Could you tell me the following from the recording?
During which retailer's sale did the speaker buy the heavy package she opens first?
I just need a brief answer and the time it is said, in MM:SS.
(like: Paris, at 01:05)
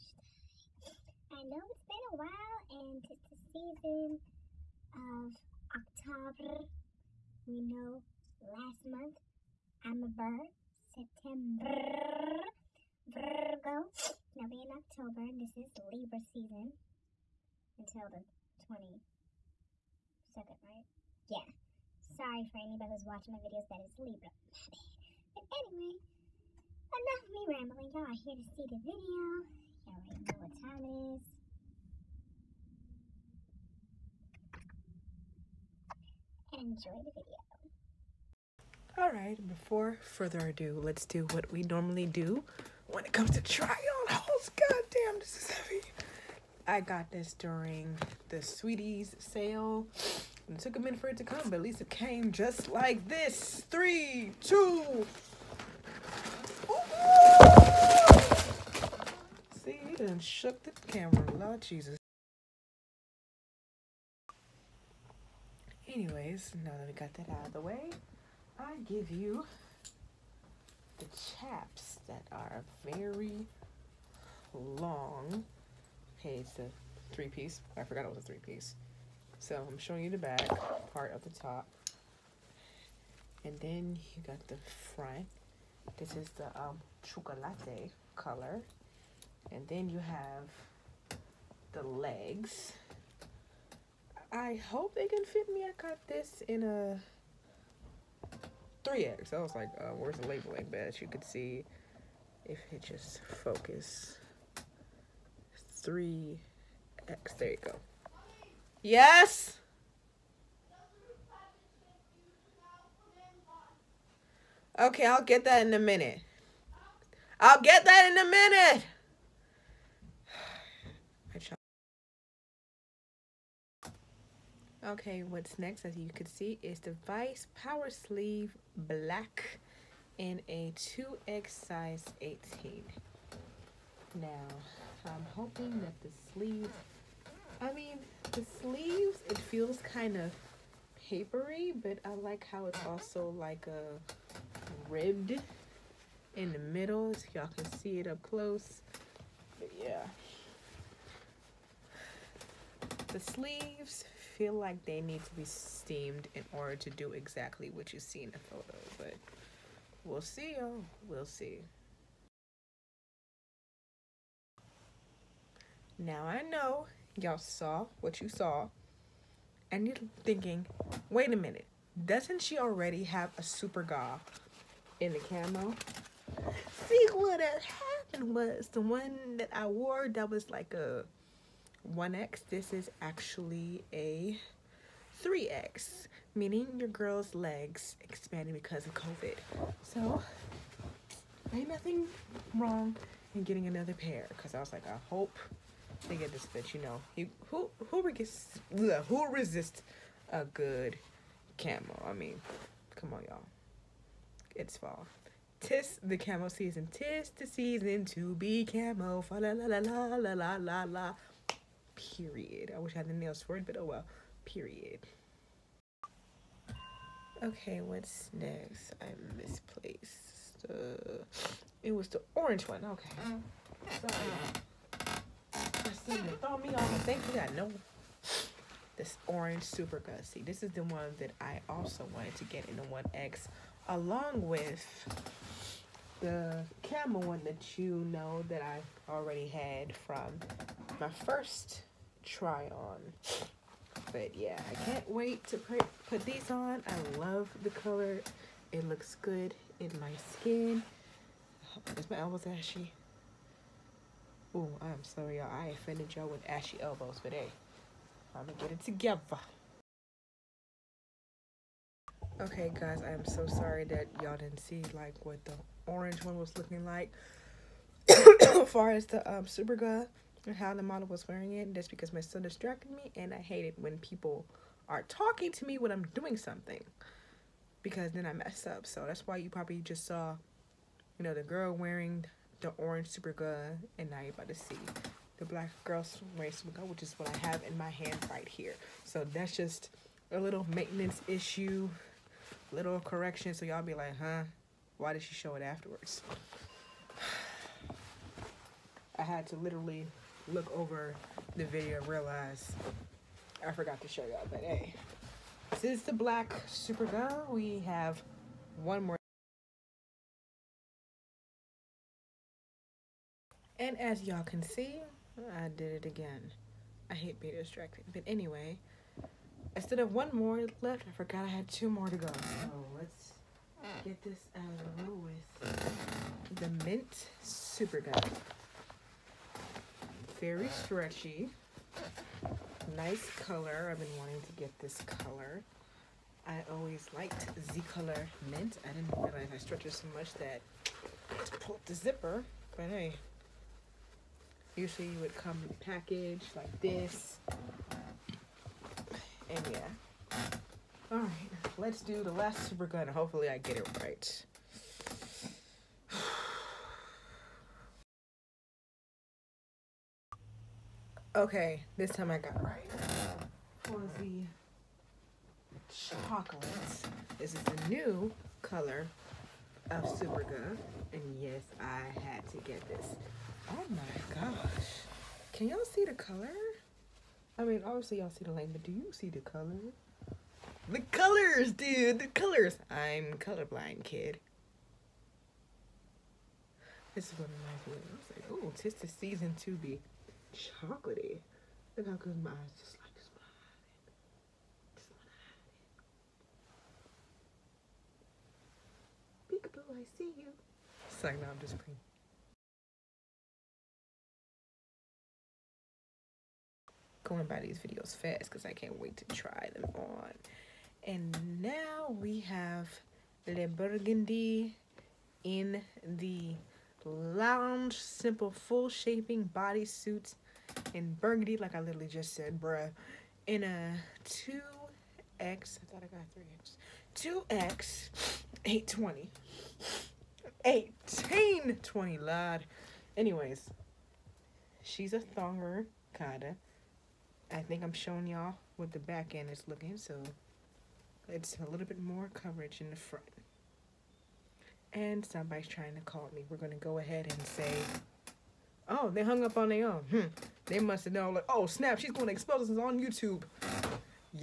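Sweeties, at 00:48.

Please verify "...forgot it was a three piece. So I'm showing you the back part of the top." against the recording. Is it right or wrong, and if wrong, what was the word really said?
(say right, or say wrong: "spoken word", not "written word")
right.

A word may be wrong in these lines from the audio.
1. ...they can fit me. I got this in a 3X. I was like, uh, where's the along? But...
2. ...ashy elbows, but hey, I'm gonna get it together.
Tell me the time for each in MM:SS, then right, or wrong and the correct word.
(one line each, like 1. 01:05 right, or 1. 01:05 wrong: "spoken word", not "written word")
1. 01:34 wrong: "labeling", not "along"
2. 04:16 right.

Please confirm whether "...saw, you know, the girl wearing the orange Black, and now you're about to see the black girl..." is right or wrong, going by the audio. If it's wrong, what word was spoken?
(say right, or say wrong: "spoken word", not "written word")
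wrong: "SuperGa", not "Black".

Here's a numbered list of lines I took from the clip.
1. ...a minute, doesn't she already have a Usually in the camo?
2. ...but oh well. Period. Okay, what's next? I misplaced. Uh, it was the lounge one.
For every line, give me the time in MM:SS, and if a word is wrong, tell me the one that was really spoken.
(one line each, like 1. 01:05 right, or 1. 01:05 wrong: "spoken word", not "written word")
1. 02:51 wrong: "SuperGa", not "Usually"
2. 03:33 wrong: "orange", not "lounge".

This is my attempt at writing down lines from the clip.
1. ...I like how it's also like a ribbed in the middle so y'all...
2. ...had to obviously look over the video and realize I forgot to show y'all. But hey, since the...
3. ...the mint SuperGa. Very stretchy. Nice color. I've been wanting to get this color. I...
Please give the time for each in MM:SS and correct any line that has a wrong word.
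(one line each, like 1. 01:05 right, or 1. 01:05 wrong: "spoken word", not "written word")
1. 02:22 right
2. 04:59 wrong: "literally", not "obviously"
3. 05:26 right.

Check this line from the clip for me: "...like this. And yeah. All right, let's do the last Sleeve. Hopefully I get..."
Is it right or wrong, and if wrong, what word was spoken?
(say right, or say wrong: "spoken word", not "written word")
wrong: "SuperGa", not "Sleeve".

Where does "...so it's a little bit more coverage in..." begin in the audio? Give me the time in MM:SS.
07:19.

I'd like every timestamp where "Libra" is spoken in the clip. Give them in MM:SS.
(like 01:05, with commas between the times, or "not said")
00:15, 00:23.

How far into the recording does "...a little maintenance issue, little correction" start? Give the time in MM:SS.
04:50.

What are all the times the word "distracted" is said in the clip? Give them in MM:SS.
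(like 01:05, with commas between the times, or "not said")
04:32, 05:17.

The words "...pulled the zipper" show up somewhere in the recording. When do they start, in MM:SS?
05:41.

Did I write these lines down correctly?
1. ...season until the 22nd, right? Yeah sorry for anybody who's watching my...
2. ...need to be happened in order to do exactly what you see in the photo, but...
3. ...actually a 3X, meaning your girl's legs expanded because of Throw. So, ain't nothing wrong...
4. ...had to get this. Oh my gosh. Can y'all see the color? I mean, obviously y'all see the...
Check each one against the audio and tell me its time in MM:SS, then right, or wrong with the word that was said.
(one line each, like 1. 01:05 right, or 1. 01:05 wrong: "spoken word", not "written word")
1. 00:16 right
2. 02:35 wrong: "steamed", not "happened"
3. 03:03 wrong: "COVID", not "Throw"
4. 06:12 right.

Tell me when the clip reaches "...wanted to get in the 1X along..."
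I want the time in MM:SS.
03:52.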